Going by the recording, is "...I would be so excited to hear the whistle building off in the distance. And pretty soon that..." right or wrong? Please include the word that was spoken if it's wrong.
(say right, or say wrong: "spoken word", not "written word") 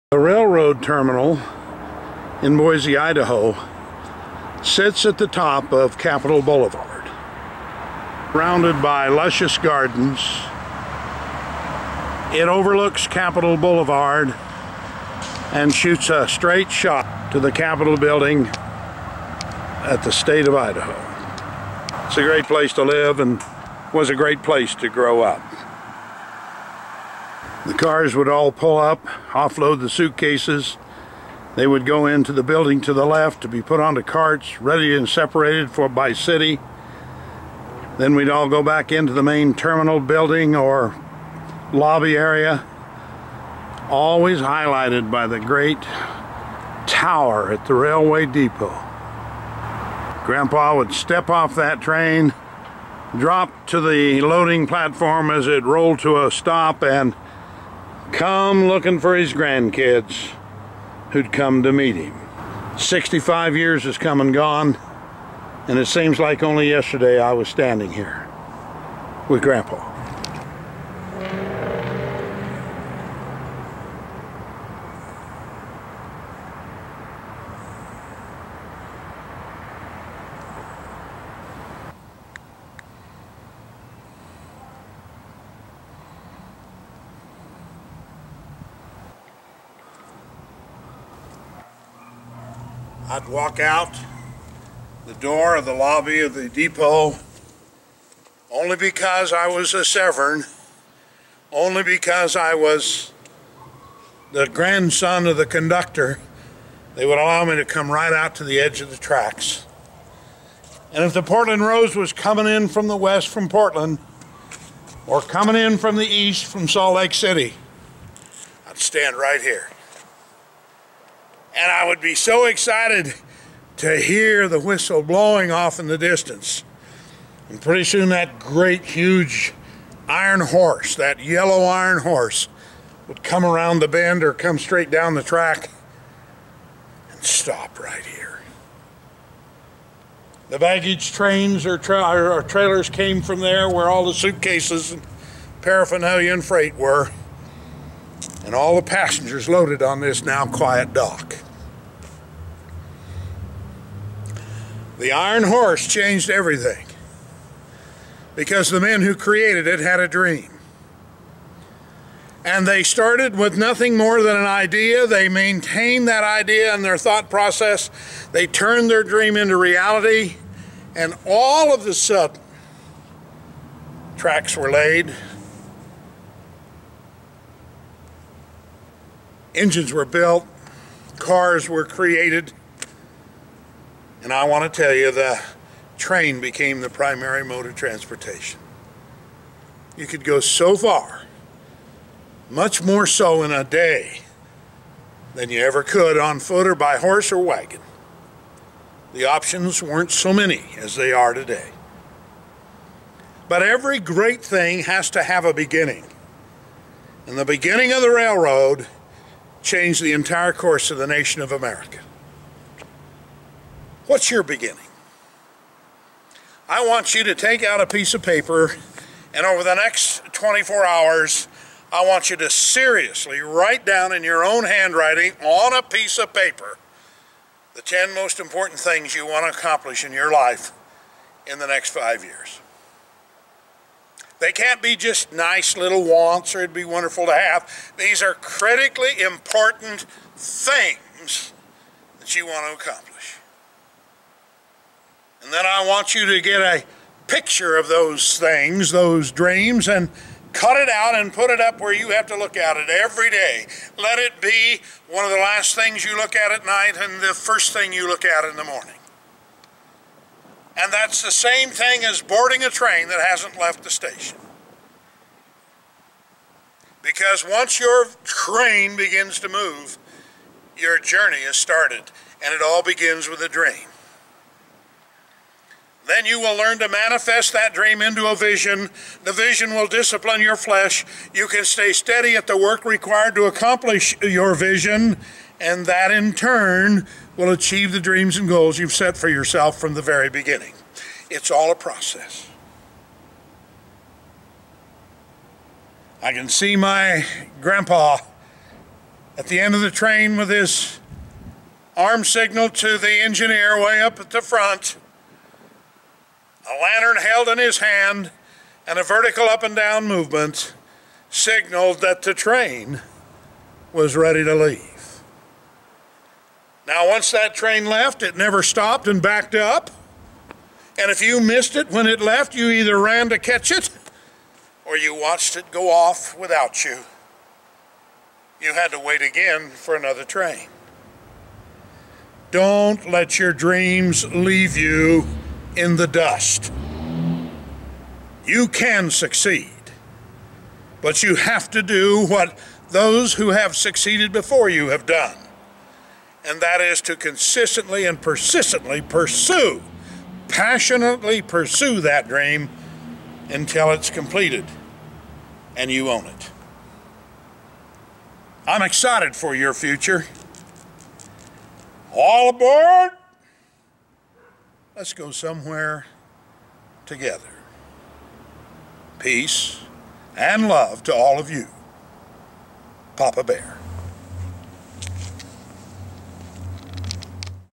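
wrong: "blowing", not "building".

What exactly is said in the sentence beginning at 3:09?
You could go so far, much more so in a day than you ever could on foot or by horse or wagon.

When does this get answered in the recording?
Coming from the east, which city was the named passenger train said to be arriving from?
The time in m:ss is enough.
1:56.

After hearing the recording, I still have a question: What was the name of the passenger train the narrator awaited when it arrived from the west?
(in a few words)
Portland Rose.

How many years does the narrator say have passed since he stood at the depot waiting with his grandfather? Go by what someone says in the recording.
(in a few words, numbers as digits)
65.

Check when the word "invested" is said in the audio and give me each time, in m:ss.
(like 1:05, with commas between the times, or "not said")
not said.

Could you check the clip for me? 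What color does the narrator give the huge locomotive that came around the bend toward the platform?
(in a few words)
Yellow.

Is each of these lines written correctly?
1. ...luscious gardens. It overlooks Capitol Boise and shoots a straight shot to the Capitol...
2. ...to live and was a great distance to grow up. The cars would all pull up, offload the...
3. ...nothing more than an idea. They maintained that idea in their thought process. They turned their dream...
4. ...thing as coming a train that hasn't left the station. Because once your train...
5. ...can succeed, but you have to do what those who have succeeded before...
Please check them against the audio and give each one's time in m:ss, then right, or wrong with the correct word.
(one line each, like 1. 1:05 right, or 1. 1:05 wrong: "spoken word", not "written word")
1. 0:09 wrong: "Boulevard", not "Boise"
2. 0:22 wrong: "place", not "distance"
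3. 2:43 right
4. 4:21 wrong: "boarding", not "coming"
5. 5:38 right.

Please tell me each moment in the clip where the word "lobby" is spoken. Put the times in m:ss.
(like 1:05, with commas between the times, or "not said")
0:41, 1:35.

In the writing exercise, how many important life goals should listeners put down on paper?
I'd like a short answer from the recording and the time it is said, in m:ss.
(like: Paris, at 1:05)
10, at 3:47.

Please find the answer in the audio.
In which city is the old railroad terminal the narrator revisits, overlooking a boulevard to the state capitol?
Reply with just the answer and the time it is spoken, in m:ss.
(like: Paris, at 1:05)
Boise, Idaho, at 0:02.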